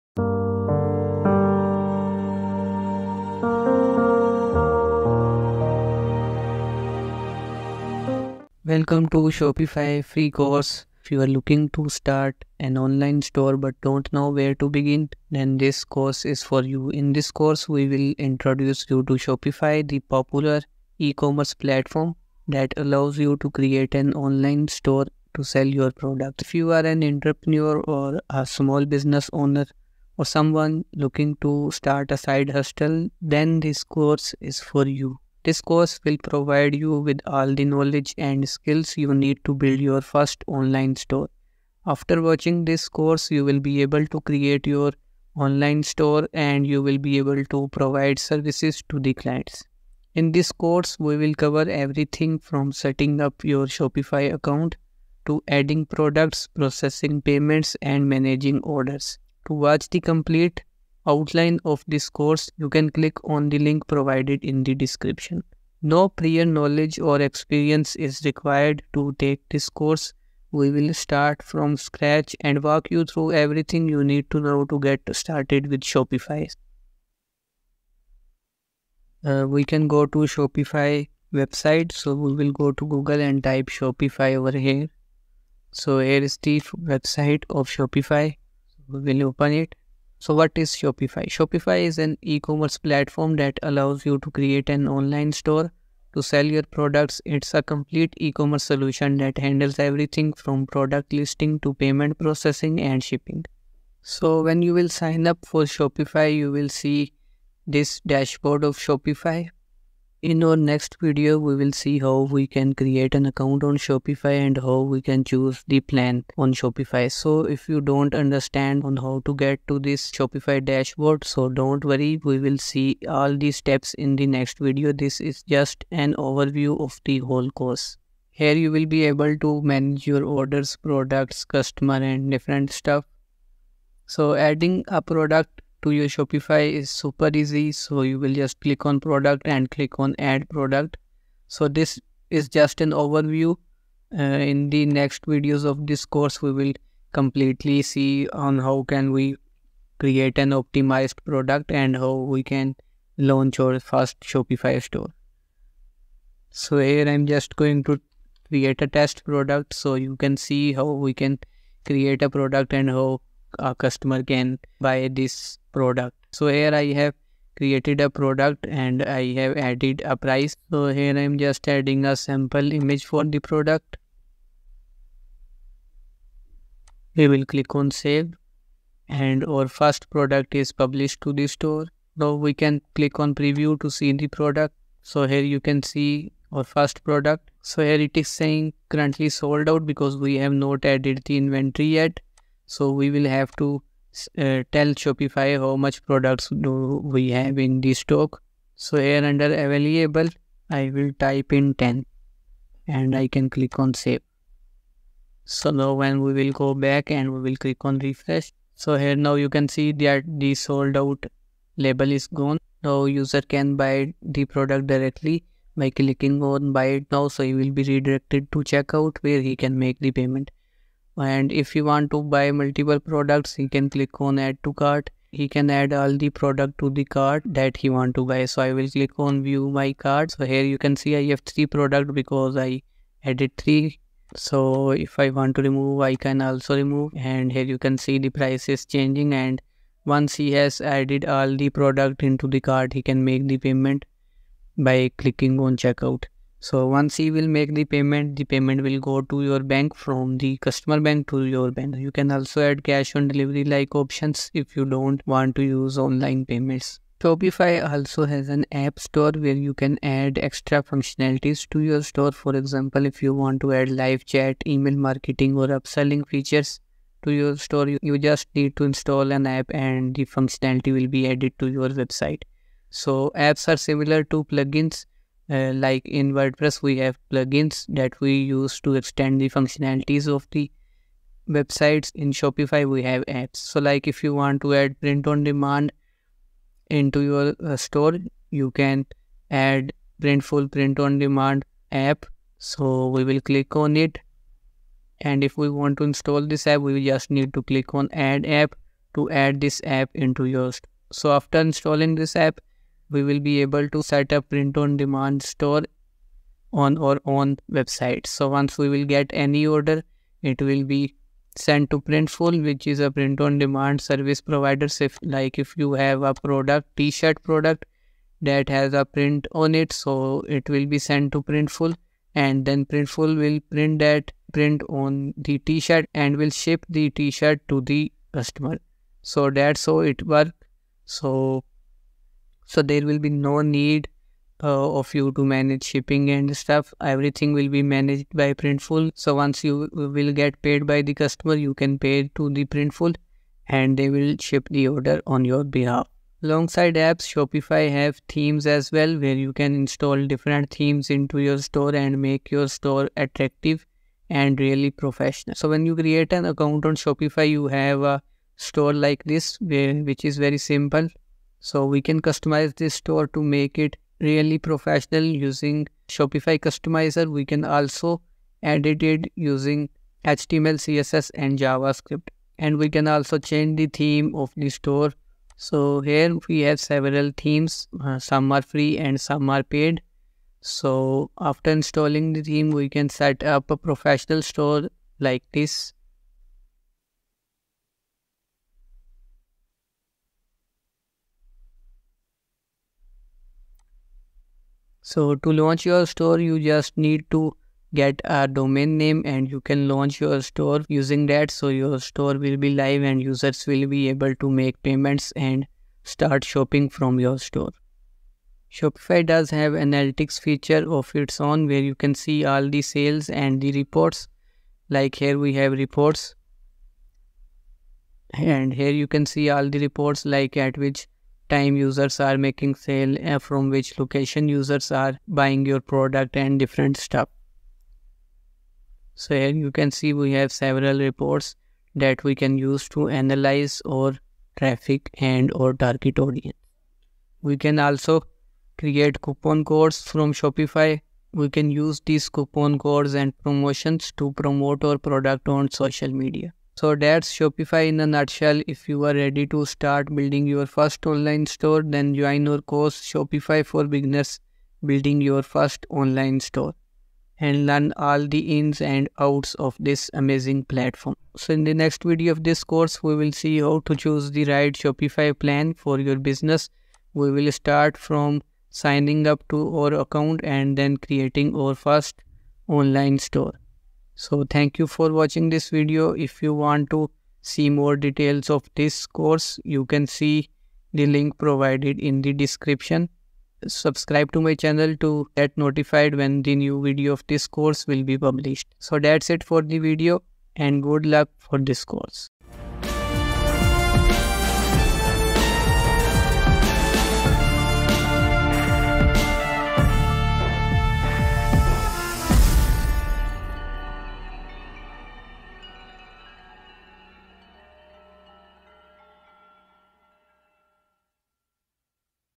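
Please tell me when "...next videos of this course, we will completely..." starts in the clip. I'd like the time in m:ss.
2:24.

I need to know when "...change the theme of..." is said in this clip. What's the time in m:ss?
6:13.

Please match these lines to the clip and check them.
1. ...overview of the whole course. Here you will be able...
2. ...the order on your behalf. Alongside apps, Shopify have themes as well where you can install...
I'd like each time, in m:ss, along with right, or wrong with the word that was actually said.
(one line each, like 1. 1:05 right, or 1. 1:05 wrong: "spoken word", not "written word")
1. 2:06 right
2. 5:44 right.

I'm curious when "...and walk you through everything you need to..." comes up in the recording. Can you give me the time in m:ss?
1:12.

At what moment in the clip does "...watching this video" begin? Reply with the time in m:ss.
7:55.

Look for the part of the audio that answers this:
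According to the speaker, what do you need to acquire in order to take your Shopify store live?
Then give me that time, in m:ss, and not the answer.
6:38.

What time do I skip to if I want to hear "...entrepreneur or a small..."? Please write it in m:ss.
0:27.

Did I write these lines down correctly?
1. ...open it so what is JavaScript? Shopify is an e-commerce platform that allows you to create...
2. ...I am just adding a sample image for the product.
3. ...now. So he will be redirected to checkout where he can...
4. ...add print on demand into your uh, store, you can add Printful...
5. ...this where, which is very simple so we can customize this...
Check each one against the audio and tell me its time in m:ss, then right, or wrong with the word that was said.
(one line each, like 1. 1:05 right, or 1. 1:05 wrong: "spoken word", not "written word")
1. 1:29 wrong: "Shopify", not "JavaScript"
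2. 2:51 right
3. 3:37 right
4. 4:44 right
5. 5:59 right.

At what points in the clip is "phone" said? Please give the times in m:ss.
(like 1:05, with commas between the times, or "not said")
not said.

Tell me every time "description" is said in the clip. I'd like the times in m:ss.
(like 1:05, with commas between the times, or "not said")
1:04, 8:02.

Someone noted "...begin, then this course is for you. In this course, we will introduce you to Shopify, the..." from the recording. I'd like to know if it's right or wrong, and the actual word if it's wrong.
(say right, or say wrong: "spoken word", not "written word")
right.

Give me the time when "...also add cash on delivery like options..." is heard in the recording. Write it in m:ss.
4:12.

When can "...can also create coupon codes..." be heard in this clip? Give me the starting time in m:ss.
7:17.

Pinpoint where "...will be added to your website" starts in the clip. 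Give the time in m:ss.
4:30.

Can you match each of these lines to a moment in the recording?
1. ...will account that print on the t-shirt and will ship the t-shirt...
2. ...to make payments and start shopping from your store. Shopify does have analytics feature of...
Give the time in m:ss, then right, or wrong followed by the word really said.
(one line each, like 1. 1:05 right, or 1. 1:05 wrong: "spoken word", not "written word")
1. 5:23 wrong: "print", not "account"
2. 6:44 right.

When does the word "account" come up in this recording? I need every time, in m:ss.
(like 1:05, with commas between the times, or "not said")
0:54, 1:53, 5:56, 7:49.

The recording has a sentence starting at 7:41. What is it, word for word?
So in the next video of this course, we will see how to choose the right Shopify plan for your business.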